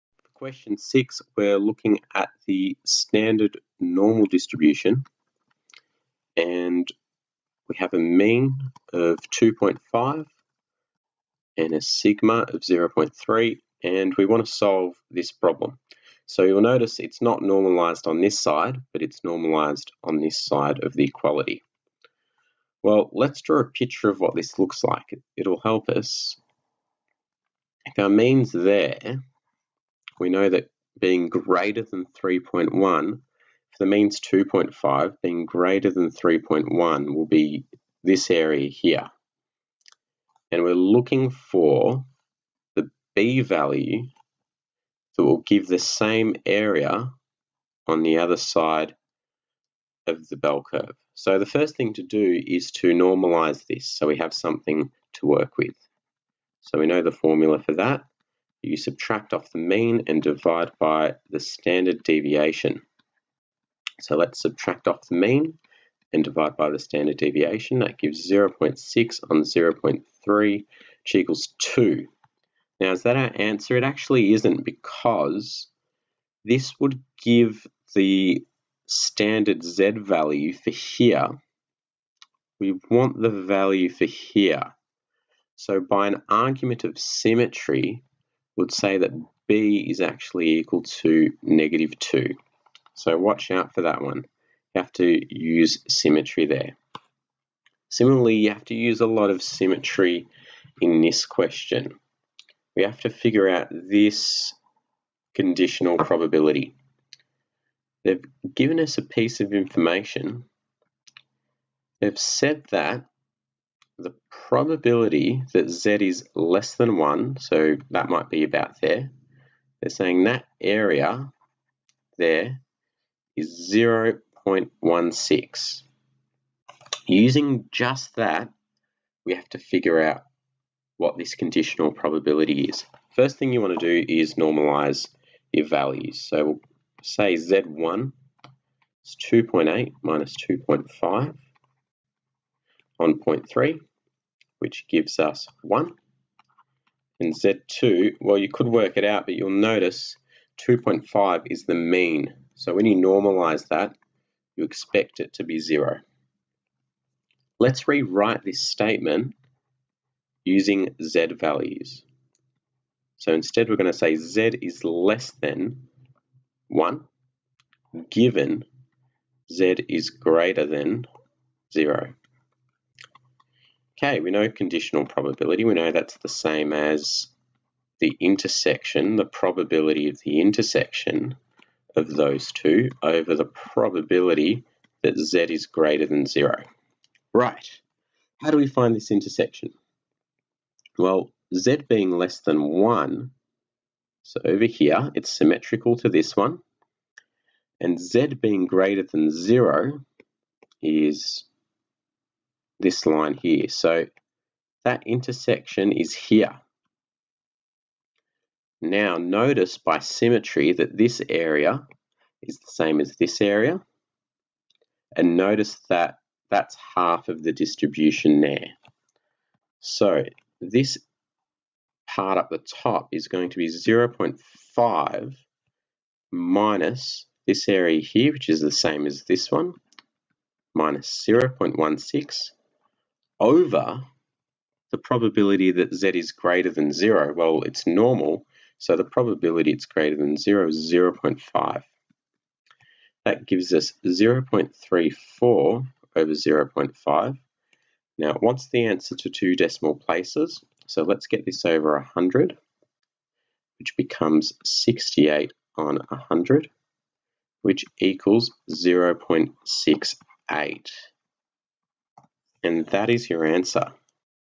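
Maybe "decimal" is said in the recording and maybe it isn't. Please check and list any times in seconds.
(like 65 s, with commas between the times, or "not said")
249 s.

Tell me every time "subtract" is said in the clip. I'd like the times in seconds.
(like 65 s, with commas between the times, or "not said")
58 s, 64 s.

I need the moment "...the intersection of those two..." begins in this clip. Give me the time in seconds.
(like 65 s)
180 s.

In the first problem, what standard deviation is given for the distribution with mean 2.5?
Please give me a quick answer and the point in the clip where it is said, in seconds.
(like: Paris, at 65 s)
0.3, at 11 s.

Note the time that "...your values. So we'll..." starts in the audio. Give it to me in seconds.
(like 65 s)
135 s.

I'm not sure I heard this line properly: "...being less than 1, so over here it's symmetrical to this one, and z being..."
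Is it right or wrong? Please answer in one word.
right.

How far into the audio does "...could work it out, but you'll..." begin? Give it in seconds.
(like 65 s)
148 s.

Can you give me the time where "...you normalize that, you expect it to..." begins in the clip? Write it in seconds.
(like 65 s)
152 s.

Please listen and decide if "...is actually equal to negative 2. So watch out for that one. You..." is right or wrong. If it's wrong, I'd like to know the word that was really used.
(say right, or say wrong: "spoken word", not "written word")
right.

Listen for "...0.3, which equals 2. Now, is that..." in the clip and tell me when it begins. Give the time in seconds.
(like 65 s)
69 s.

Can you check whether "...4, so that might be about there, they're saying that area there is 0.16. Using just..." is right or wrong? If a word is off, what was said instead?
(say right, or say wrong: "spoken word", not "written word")
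wrong: "1", not "4".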